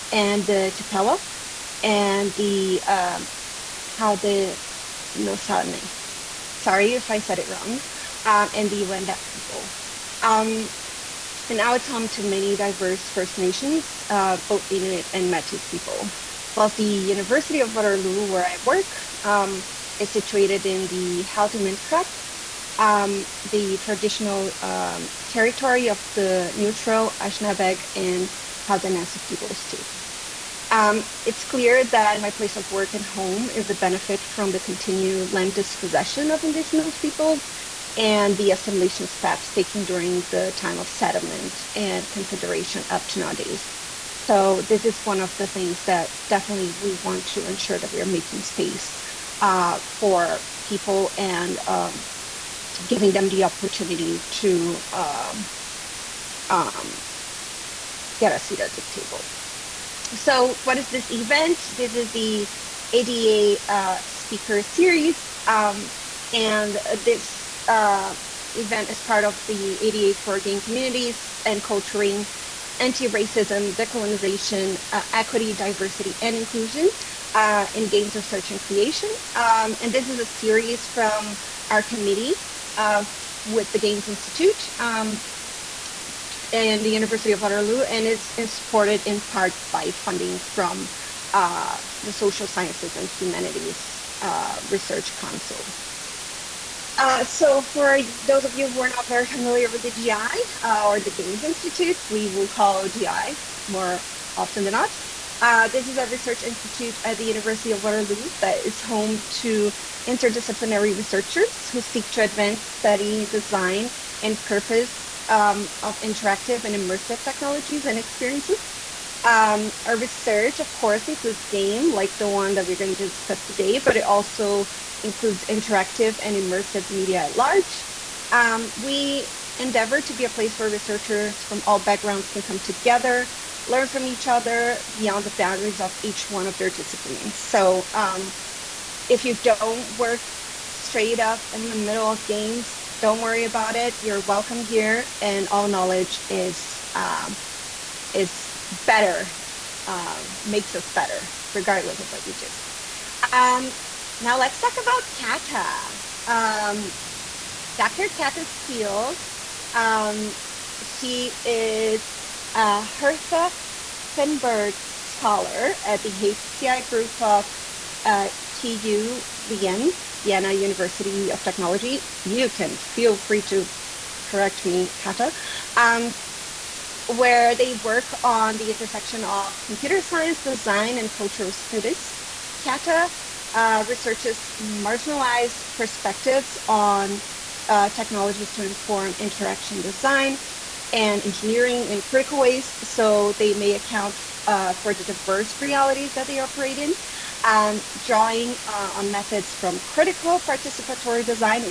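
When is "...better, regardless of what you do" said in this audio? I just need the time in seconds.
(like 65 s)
150 s.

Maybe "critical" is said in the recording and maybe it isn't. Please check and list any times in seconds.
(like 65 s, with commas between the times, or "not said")
192 s, 199 s.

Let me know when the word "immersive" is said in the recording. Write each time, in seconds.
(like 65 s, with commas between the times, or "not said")
116 s, 126 s.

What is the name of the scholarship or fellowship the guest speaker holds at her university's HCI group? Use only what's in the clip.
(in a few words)
Hertha Firnberg.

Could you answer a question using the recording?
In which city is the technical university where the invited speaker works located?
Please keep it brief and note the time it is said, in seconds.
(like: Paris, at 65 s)
Vienna, at 170 s.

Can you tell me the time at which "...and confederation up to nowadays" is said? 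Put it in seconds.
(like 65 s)
41 s.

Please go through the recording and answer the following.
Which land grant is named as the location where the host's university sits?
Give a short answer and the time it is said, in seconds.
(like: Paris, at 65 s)
Haldimand Tract, at 21 s.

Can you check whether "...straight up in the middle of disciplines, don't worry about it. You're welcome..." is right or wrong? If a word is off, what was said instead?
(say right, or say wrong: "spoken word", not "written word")
wrong: "games", not "disciplines".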